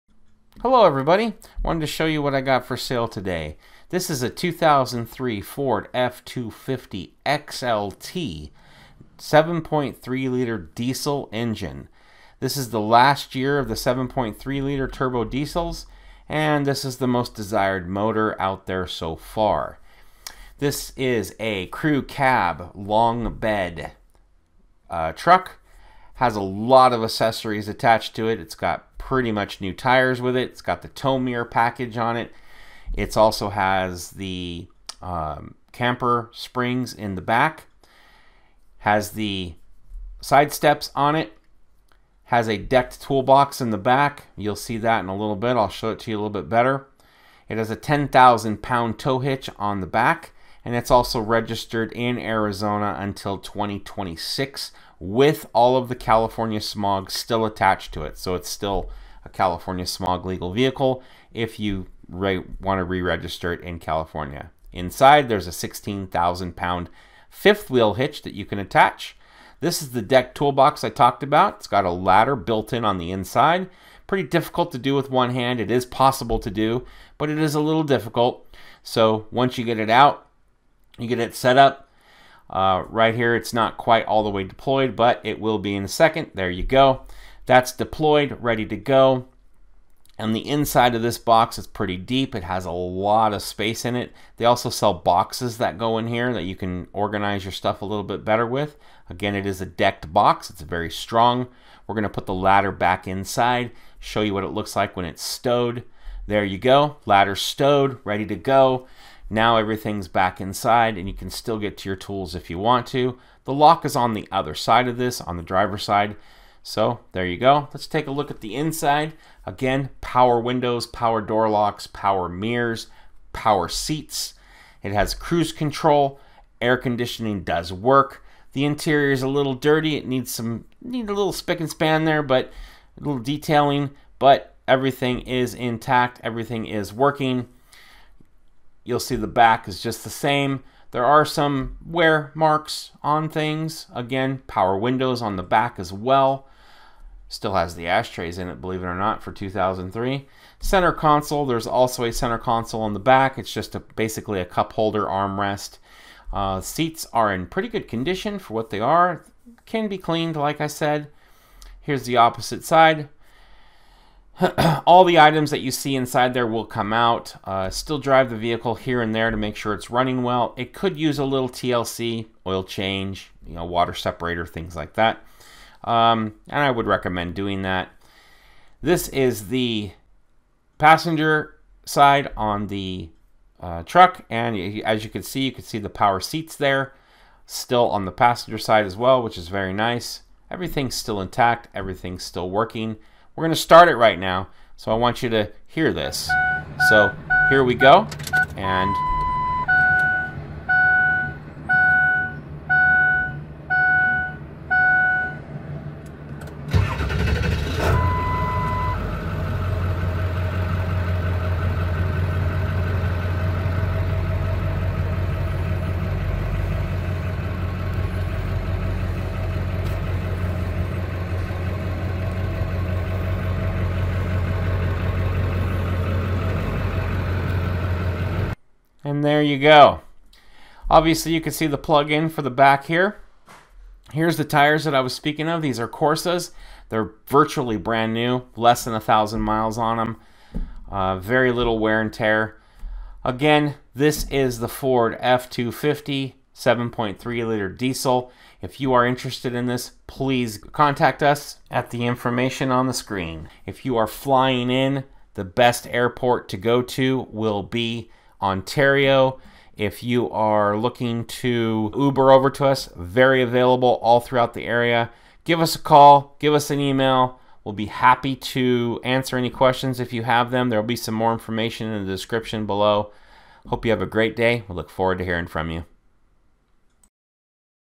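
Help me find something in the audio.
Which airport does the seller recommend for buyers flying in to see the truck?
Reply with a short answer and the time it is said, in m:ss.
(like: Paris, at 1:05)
Ontario, at 4:18.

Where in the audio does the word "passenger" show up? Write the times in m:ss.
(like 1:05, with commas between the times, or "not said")
3:00, 3:08.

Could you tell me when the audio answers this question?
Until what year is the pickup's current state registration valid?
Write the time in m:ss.
0:53.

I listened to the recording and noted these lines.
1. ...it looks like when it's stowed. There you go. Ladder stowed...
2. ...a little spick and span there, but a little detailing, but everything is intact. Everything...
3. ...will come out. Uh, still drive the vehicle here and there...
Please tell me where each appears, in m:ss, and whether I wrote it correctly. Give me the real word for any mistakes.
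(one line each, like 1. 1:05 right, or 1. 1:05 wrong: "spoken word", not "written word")
1. 1:44 right
2. 2:11 right
3. 2:46 right.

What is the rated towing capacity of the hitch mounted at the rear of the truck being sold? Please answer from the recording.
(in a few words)
10,000 pounds.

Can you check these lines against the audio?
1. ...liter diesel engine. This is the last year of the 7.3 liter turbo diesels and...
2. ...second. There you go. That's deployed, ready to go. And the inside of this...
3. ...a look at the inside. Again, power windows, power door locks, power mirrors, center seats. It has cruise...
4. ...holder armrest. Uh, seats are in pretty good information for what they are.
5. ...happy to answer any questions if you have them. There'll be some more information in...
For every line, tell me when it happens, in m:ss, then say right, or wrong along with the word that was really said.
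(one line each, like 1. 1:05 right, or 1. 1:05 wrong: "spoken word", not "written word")
1. 0:10 right
2. 1:25 right
3. 1:58 wrong: "power", not "center"
4. 2:34 wrong: "condition", not "information"
5. 4:27 right.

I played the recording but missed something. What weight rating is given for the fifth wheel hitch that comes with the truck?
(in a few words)
16,000 pounds.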